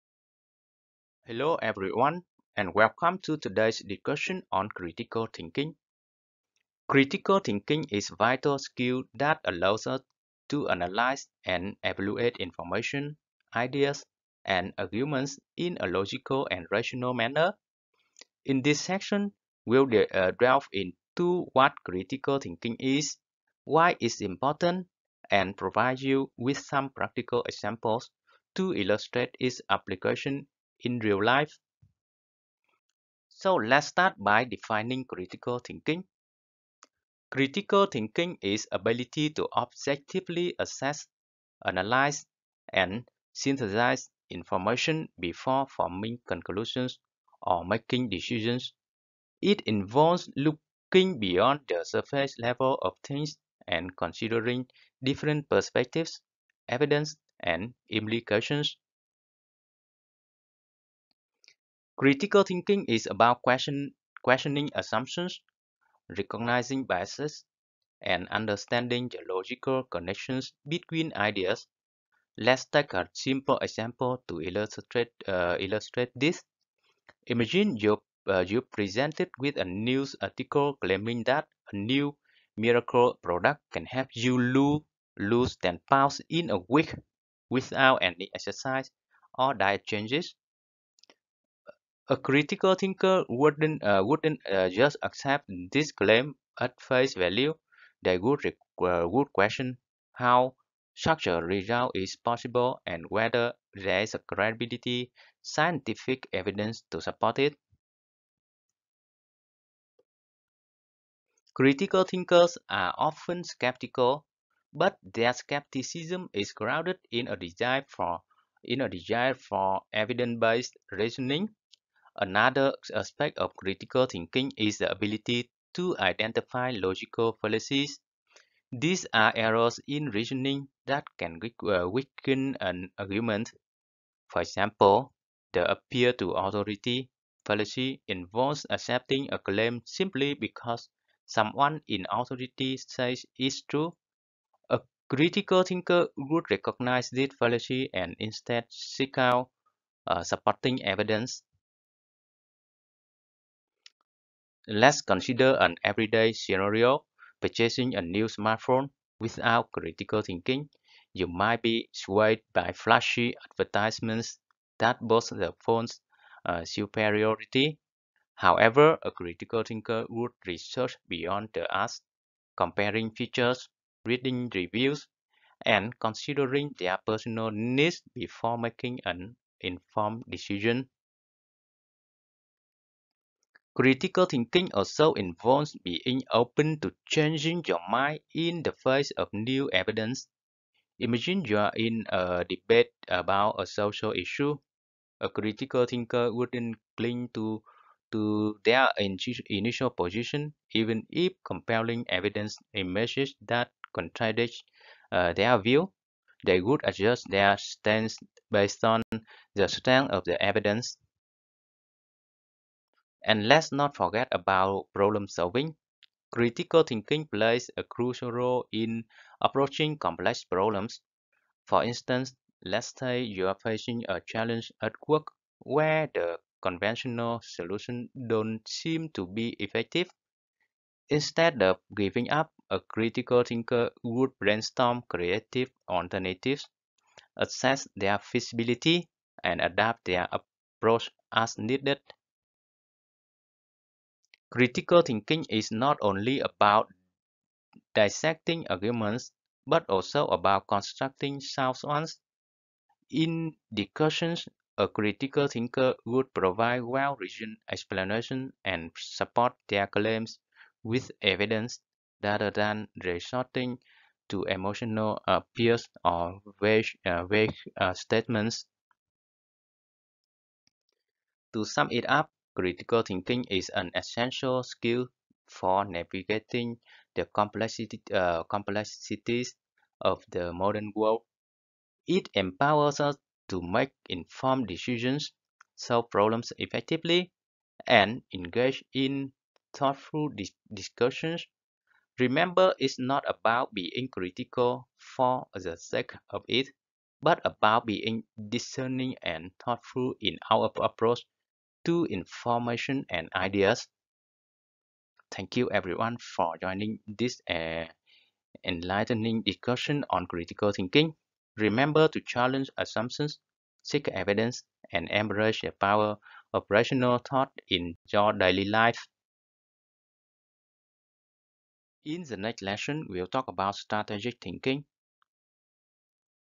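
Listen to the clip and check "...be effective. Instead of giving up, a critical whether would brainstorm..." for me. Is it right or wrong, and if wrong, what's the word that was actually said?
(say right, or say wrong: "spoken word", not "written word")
wrong: "thinker", not "whether".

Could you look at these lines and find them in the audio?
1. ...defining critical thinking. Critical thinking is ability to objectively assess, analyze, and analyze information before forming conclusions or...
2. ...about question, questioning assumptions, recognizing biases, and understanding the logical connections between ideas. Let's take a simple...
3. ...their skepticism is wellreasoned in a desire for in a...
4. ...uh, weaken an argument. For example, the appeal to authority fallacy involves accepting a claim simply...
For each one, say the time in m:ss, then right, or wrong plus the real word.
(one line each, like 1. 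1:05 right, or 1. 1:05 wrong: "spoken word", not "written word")
1. 0:34 wrong: "synthesize", not "analyze"
2. 1:03 right
3. 1:55 wrong: "grounded", not "wellreasoned"
4. 2:11 right.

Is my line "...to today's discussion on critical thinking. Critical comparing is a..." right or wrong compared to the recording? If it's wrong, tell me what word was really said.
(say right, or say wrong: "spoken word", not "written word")
wrong: "thinking", not "comparing".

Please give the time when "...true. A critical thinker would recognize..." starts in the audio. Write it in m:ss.
2:23.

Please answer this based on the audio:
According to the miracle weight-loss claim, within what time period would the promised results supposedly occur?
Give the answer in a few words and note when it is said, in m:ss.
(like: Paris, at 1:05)
a week, at 1:26.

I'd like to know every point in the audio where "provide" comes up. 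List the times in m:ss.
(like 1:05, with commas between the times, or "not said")
0:25, 4:16.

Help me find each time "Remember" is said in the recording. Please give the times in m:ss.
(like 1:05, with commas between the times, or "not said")
4:52, 5:11.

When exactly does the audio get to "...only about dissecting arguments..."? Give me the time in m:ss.
4:06.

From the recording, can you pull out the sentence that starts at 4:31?
To sum it up, Critical thinking is an essential skill for navigating the complexity, uh, complexities of the modern world.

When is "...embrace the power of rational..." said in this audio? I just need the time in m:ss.
5:15.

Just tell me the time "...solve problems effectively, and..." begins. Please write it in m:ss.
4:45.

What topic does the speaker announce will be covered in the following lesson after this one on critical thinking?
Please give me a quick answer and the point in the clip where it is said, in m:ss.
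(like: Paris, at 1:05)
strategic thinking, at 5:23.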